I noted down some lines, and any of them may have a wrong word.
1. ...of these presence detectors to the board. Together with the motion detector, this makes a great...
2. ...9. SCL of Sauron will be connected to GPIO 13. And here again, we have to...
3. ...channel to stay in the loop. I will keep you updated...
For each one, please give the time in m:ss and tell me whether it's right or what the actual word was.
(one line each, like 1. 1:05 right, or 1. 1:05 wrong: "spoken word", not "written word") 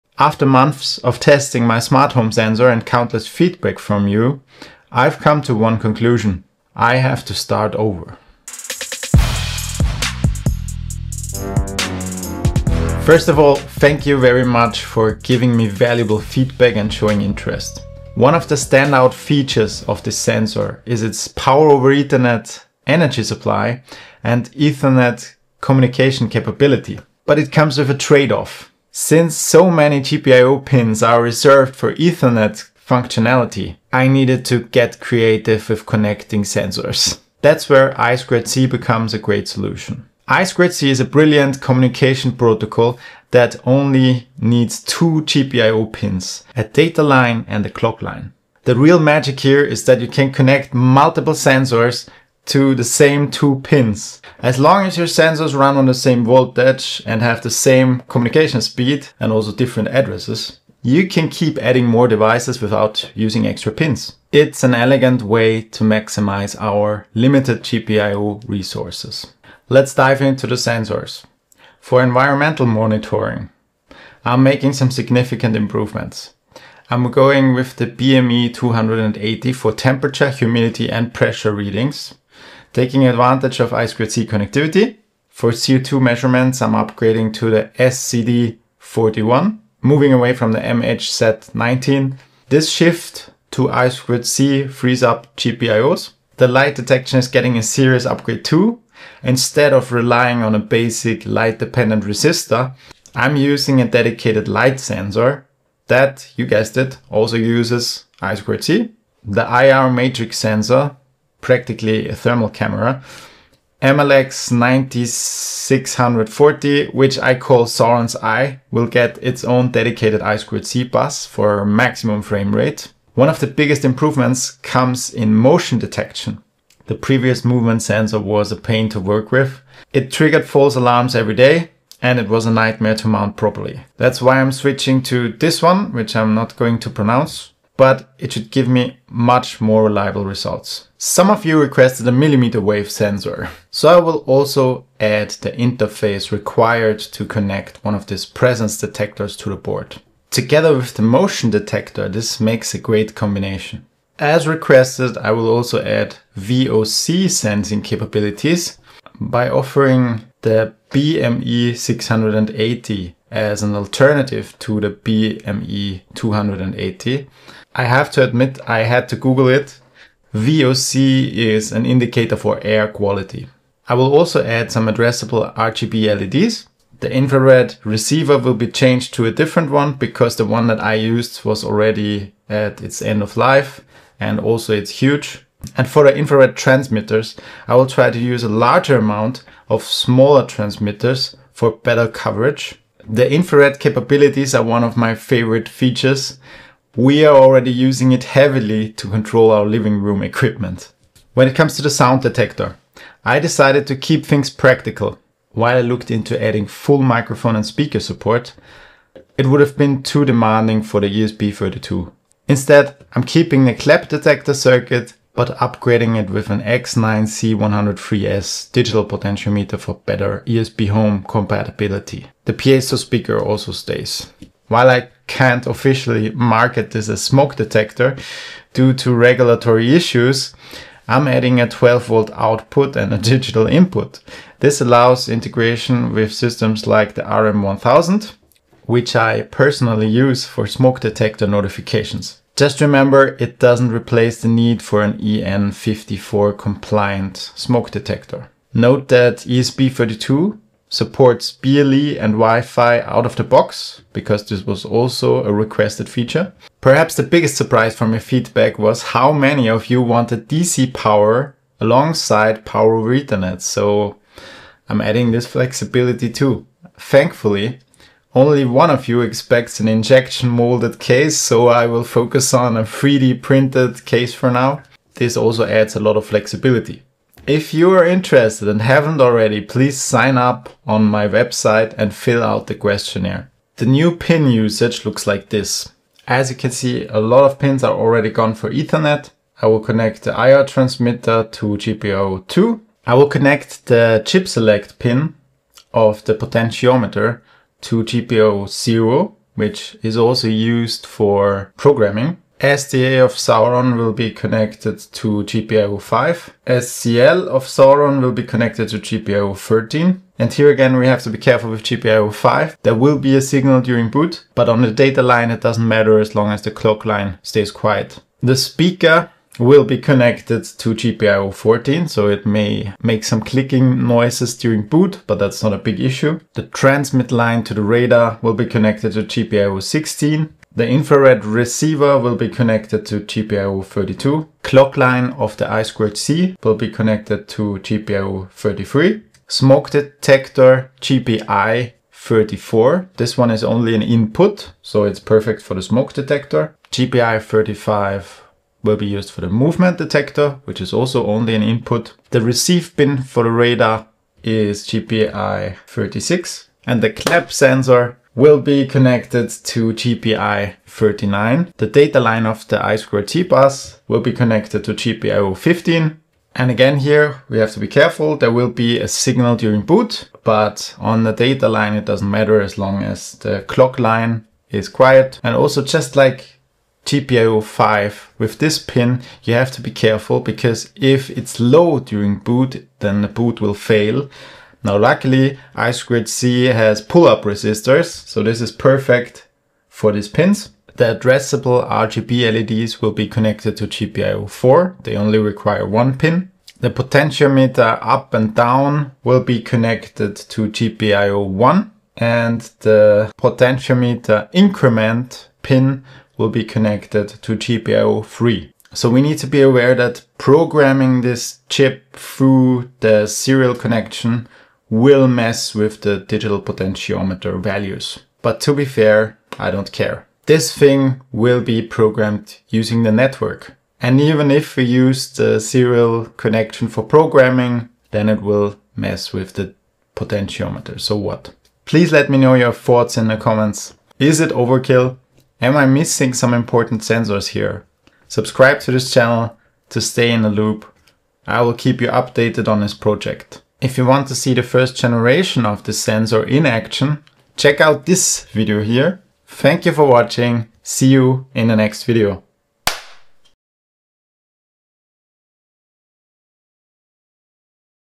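1. 2:27 right
2. 5:05 wrong: "5", not "9"
3. 7:19 right.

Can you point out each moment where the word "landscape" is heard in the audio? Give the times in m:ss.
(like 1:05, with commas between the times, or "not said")
not said.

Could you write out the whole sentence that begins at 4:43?
The new pin usage looks like this.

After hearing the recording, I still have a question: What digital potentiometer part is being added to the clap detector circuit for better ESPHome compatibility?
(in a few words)
X9C103S.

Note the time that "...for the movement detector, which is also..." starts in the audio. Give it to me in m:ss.
5:49.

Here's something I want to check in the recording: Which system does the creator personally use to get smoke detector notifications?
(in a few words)
RM1000.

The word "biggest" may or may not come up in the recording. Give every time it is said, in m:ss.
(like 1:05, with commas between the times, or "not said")
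2:03, 4:17.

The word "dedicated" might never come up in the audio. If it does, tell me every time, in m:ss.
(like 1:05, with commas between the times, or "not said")
1:43, 1:59.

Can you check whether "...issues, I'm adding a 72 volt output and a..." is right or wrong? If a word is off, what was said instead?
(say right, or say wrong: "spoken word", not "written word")
wrong: "12", not "72".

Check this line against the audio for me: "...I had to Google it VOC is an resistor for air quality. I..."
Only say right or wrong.
wrong.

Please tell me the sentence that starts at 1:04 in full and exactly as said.
It's an elegant way to maximize our limited GPIO resources.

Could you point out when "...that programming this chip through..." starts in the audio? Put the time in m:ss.
6:49.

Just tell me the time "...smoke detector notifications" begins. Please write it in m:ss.
4:00.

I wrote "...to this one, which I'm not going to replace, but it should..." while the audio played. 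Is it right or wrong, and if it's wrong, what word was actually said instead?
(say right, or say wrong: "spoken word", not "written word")
wrong: "pronounce", not "replace".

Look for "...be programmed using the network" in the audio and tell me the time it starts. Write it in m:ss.
7:01.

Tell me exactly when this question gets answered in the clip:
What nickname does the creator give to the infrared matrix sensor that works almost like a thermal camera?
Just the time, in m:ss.
1:57.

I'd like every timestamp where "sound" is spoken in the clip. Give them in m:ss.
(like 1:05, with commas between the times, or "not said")
3:21.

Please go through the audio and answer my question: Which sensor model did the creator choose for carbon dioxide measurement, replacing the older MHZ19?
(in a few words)
SCD41.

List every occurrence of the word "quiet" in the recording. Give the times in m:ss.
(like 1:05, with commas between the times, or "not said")
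5:17, 6:14.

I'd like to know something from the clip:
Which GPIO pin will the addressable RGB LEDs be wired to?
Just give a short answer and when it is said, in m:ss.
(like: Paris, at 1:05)
GPIO 4, at 6:33.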